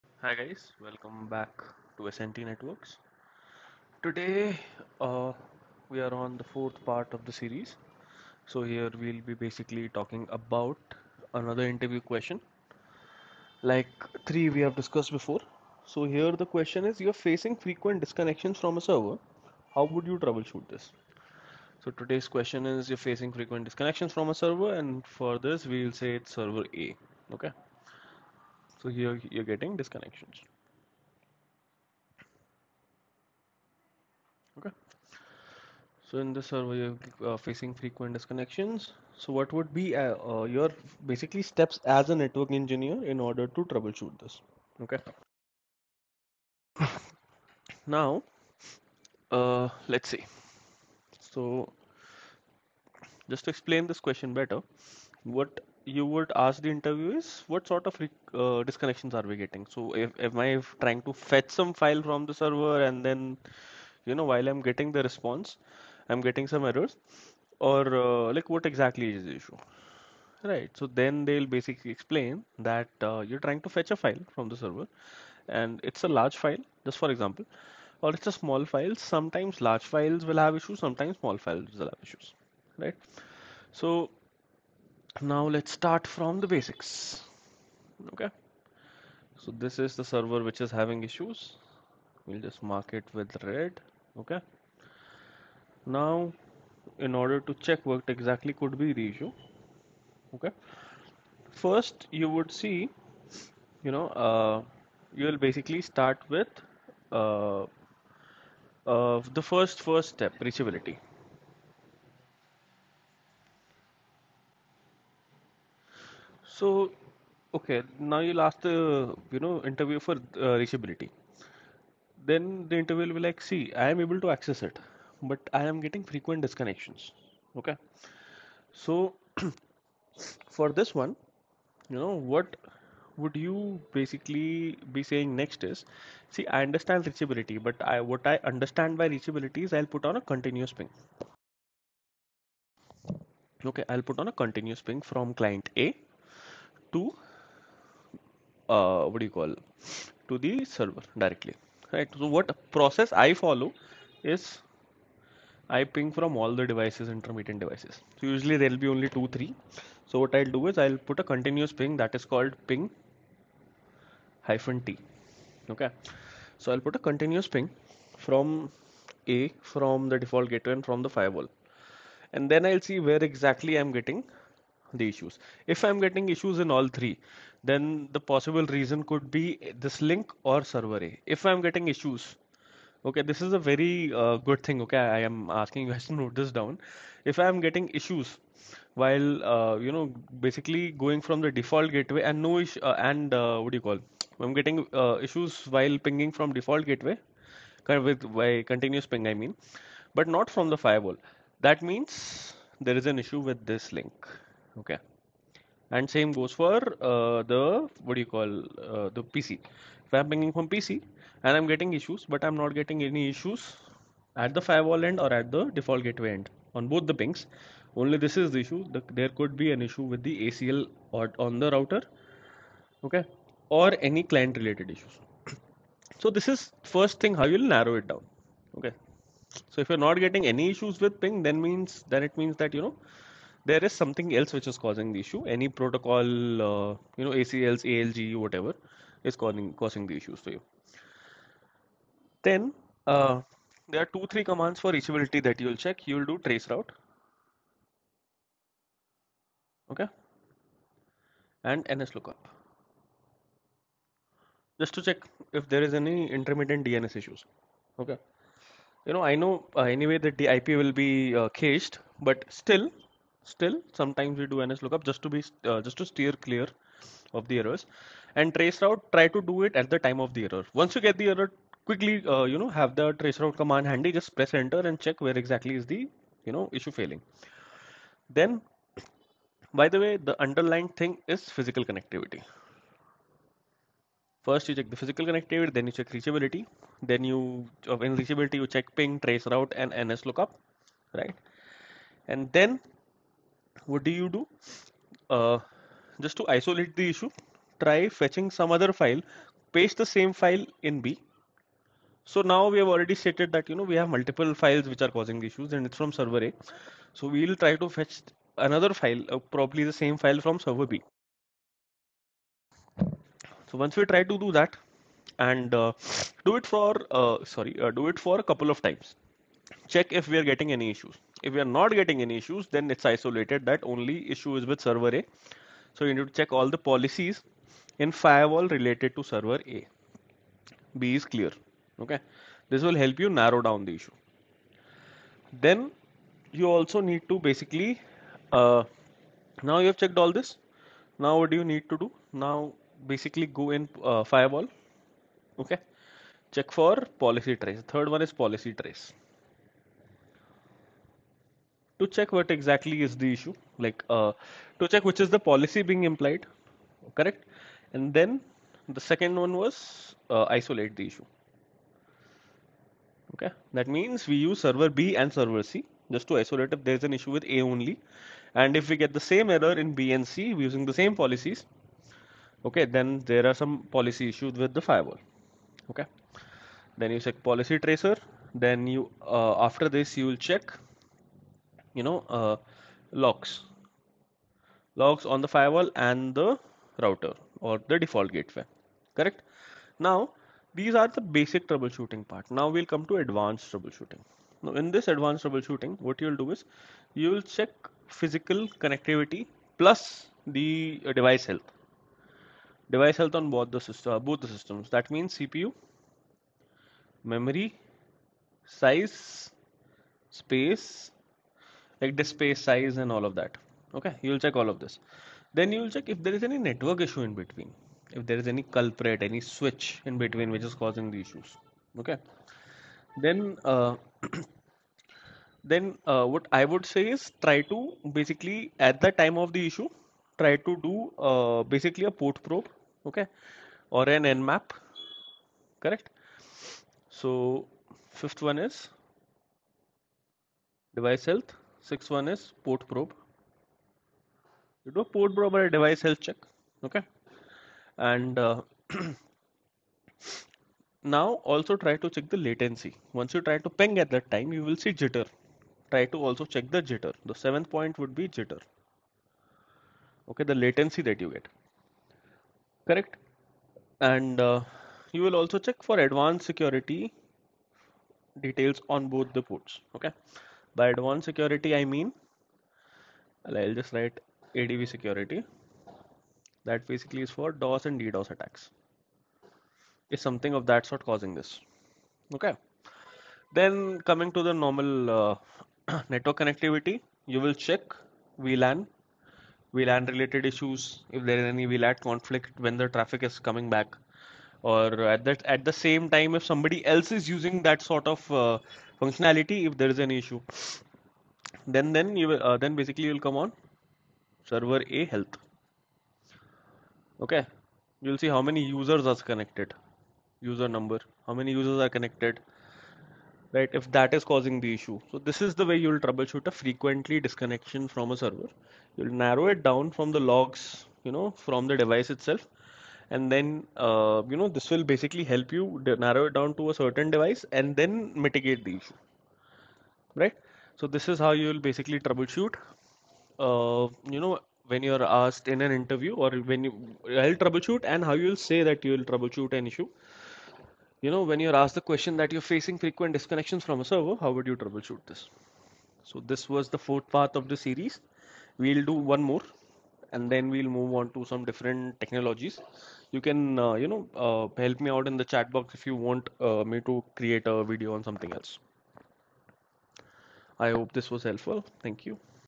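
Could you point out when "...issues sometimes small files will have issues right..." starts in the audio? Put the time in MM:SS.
01:20.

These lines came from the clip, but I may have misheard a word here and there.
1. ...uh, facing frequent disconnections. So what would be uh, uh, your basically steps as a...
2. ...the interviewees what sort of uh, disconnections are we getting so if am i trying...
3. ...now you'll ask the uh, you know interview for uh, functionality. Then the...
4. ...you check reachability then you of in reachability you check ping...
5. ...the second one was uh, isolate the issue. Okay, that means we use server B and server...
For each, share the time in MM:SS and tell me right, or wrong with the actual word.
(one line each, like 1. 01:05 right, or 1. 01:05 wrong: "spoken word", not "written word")
1. 00:37 right
2. 00:56 right
3. 01:57 wrong: "reachability", not "functionality"
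4. 04:45 right
5. 05:58 right.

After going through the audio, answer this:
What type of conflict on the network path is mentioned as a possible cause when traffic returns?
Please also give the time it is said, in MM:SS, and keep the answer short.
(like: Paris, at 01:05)
VLAN conflict, at 08:11.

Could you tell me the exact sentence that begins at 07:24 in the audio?
You do port probe or a device health check.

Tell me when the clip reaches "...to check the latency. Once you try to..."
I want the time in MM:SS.
07:31.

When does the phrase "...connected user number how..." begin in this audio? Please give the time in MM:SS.
08:29.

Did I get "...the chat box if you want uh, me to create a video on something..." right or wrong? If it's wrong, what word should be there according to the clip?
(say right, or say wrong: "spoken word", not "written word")
right.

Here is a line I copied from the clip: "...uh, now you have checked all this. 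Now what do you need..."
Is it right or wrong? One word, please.
right.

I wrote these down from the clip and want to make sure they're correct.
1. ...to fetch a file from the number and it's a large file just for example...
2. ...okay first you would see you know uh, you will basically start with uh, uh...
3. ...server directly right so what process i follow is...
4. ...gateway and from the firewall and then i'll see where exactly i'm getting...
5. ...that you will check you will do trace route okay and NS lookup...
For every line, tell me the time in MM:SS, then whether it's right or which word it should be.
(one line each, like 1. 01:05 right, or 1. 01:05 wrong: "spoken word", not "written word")
1. 01:13 wrong: "server", not "number"
2. 01:40 right
3. 02:30 right
4. 02:50 right
5. 04:05 right.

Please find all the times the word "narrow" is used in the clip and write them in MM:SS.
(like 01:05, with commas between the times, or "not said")
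03:47, 05:33, 08:39, 08:46.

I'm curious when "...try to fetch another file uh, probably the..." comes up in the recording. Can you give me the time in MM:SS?
05:07.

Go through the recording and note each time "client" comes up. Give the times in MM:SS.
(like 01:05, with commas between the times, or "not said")
02:25, 03:44.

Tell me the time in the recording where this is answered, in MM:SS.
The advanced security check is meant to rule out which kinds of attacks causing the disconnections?
07:57.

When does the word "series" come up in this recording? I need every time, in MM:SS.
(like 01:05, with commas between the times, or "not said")
00:07, 09:07.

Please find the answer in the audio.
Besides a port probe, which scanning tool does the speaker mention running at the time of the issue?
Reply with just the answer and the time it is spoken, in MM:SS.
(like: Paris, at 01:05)
nmap, at 07:14.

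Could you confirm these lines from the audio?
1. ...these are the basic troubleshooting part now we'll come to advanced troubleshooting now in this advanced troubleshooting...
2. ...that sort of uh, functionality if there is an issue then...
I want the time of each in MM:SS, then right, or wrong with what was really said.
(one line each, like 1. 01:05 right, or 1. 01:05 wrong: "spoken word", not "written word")
1. 06:30 right
2. 08:17 right.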